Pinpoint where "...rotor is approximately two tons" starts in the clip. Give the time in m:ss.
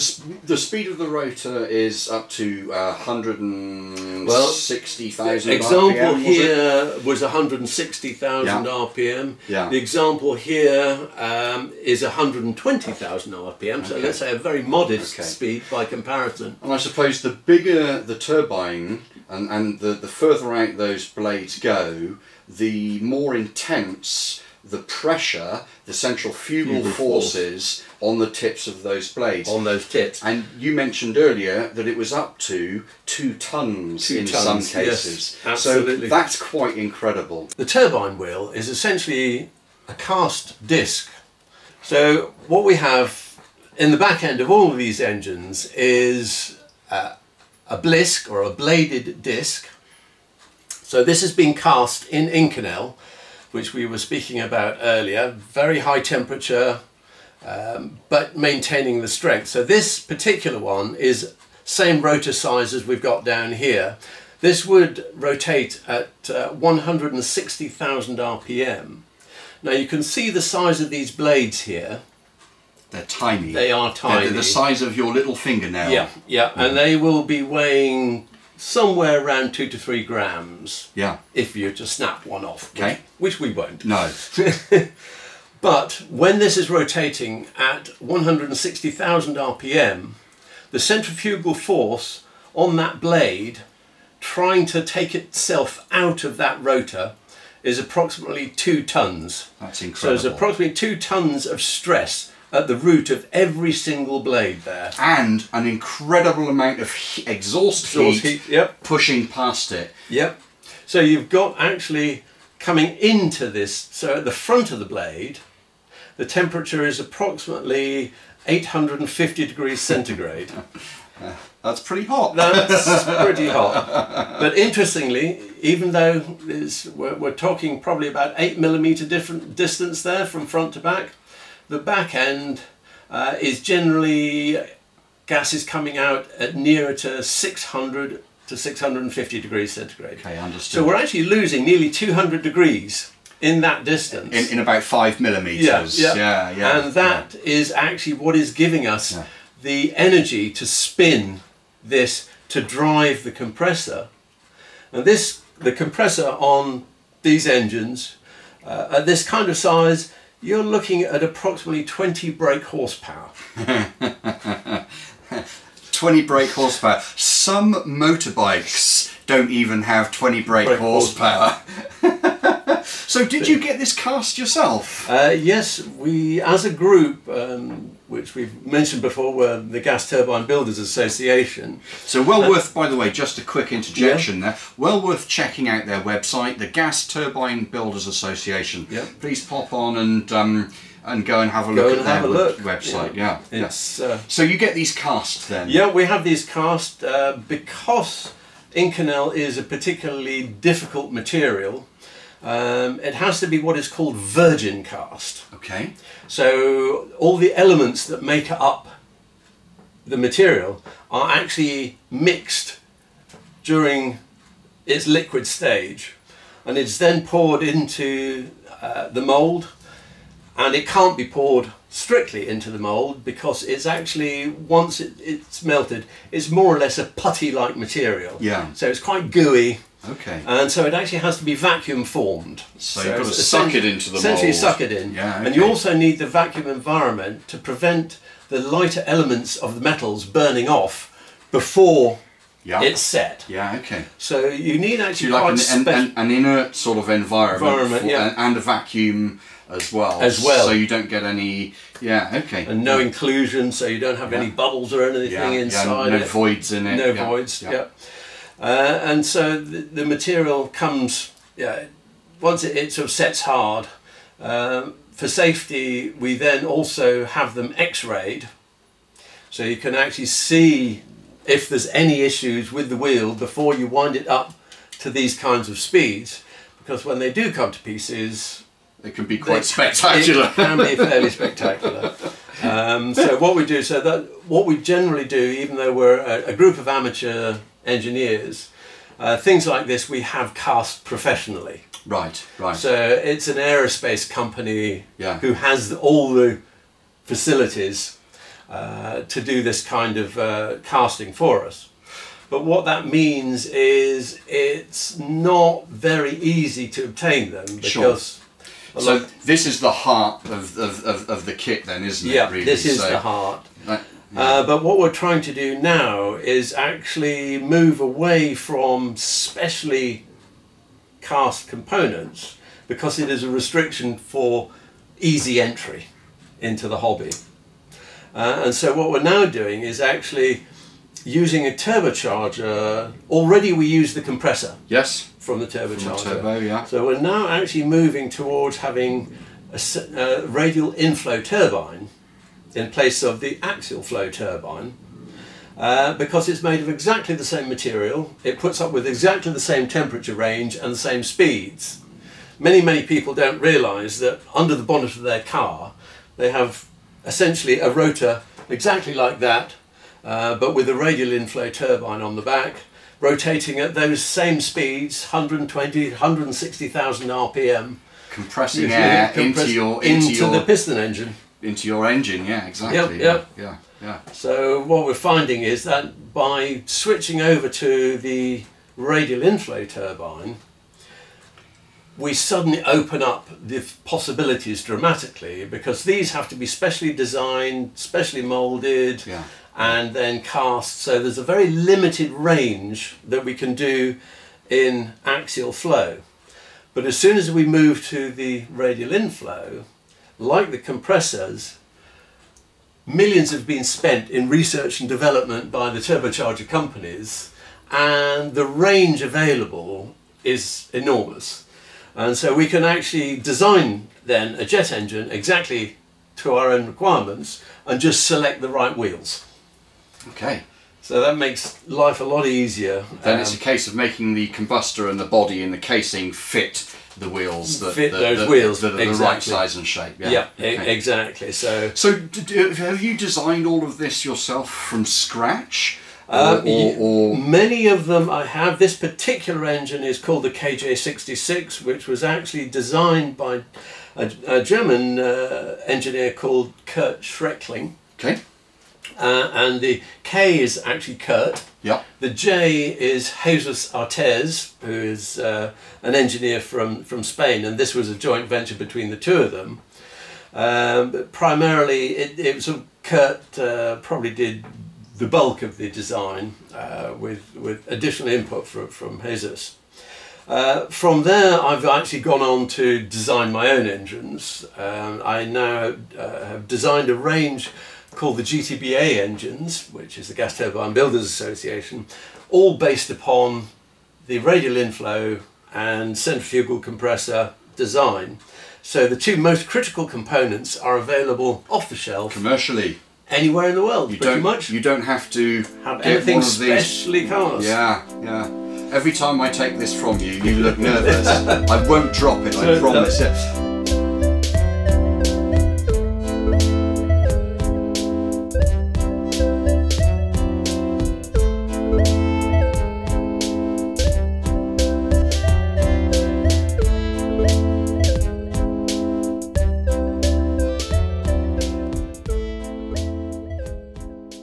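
1:36.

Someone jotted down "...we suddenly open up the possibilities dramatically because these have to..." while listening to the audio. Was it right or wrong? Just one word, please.
right.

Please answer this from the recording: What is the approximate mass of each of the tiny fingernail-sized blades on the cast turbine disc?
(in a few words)
2 to 3 grams.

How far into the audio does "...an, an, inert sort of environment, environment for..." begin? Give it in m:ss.
4:05.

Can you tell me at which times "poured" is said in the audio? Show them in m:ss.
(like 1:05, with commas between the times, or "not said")
3:37, 3:41.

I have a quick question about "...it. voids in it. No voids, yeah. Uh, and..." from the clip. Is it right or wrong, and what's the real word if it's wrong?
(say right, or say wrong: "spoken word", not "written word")
right.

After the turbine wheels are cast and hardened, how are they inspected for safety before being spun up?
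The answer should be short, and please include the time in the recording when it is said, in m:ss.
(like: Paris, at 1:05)
X-rayed, at 4:27.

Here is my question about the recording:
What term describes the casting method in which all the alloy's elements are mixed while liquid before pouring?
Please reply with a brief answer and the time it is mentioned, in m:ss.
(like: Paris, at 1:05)
virgin cast, at 3:24.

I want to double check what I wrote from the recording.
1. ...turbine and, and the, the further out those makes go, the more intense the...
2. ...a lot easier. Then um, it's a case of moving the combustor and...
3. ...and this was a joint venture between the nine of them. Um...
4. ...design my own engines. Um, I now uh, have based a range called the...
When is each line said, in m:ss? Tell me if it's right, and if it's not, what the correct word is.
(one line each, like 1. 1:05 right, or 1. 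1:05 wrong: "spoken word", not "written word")
1. 0:18 wrong: "blades", not "makes"
2. 7:02 wrong: "making", not "moving"
3. 7:37 wrong: "two", not "nine"
4. 7:53 wrong: "designed", not "based".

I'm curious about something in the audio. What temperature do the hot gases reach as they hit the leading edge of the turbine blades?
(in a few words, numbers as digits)
850 degrees centigrade.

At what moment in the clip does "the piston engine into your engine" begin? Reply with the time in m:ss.
6:10.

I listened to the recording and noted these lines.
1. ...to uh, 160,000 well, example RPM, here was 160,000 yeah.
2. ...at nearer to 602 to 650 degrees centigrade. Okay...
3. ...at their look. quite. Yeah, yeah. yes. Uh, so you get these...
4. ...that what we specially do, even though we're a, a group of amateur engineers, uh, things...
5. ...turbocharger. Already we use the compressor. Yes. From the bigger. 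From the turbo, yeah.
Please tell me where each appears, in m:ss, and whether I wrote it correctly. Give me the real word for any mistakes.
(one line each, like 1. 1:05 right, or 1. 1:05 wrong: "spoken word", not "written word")
1. 0:02 right
2. 2:16 wrong: "600", not "602"
3. 3:12 wrong: "website", not "quite"
4. 4:43 wrong: "generally", not "specially"
5. 5:31 wrong: "turbocharger", not "bigger".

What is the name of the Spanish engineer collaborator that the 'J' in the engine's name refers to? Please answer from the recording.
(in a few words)
Jesus Artes.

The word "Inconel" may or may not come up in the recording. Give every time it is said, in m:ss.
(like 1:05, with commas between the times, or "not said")
0:52, 3:18.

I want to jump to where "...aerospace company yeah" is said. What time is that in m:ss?
4:53.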